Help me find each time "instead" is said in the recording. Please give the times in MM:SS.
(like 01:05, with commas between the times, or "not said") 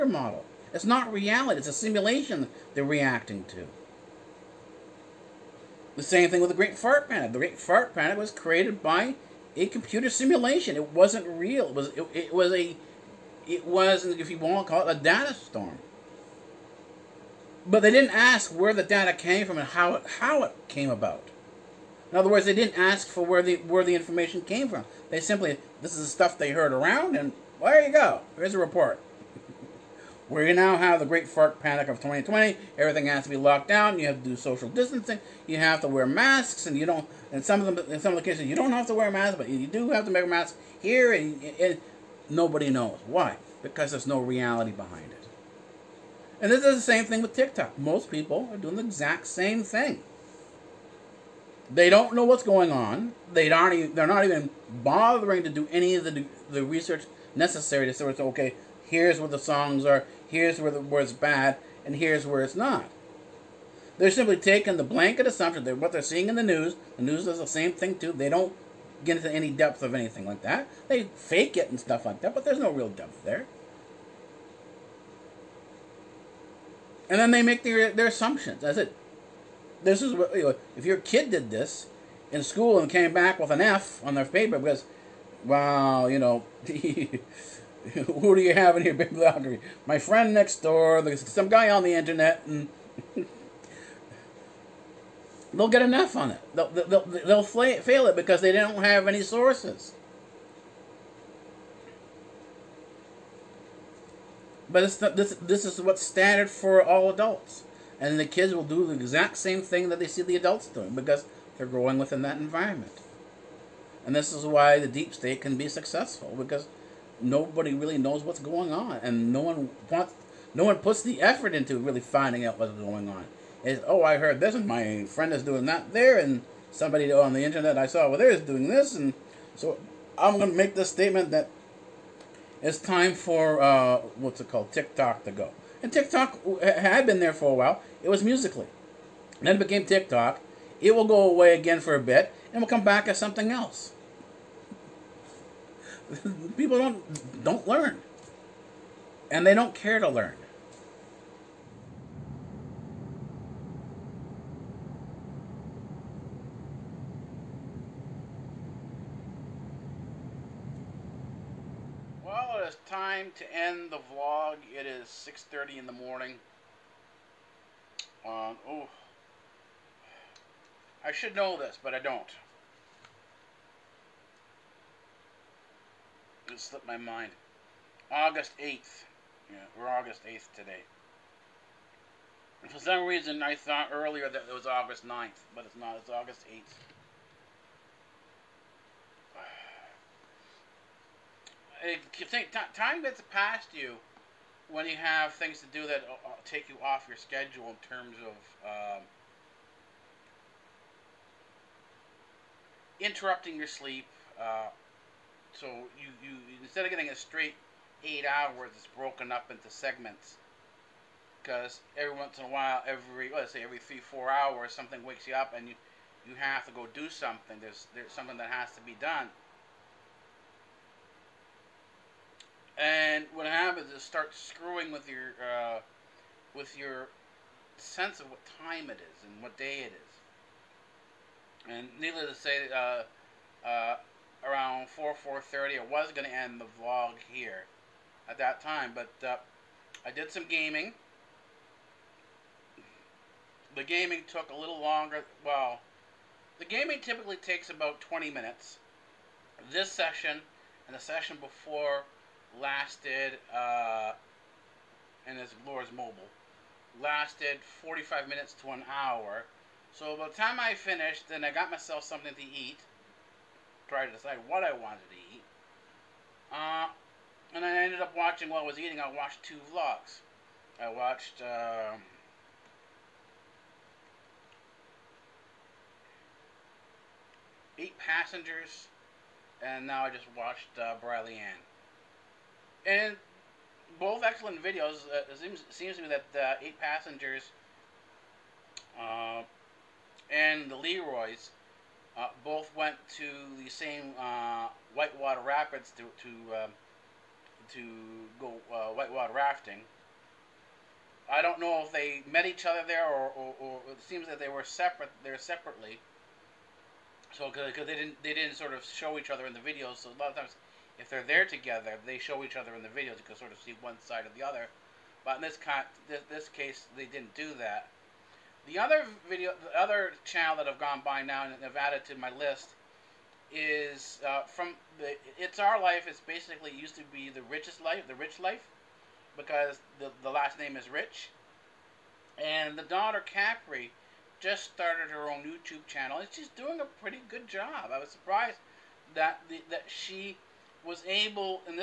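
03:26.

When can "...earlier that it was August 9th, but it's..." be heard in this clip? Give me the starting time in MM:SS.
03:03.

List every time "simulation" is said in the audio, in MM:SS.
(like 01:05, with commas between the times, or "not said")
00:01, 00:10.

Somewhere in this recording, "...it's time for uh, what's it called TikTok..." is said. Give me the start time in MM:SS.
02:12.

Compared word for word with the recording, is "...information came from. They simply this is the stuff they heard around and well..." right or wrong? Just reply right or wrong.
right.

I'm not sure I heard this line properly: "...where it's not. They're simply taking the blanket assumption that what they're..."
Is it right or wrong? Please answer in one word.
right.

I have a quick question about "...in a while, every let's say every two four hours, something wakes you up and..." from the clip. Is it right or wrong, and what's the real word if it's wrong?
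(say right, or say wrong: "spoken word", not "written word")
wrong: "three", not "two".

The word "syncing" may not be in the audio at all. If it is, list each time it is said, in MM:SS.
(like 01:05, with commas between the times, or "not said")
not said.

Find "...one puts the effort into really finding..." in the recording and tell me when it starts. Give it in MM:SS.
02:00.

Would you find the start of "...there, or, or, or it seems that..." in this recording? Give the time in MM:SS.
05:02.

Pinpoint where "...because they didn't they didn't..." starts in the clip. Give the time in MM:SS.
05:07.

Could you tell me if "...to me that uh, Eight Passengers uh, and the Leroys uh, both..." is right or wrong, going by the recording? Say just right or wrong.
right.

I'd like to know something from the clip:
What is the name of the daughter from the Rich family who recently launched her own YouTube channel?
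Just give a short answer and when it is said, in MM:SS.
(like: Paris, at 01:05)
Capri, at 05:33.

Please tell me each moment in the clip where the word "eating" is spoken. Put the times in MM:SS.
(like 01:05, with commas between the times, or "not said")
04:28.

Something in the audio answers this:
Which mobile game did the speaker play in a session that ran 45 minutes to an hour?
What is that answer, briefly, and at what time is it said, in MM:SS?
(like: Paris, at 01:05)
Lords Mobile, at 04:15.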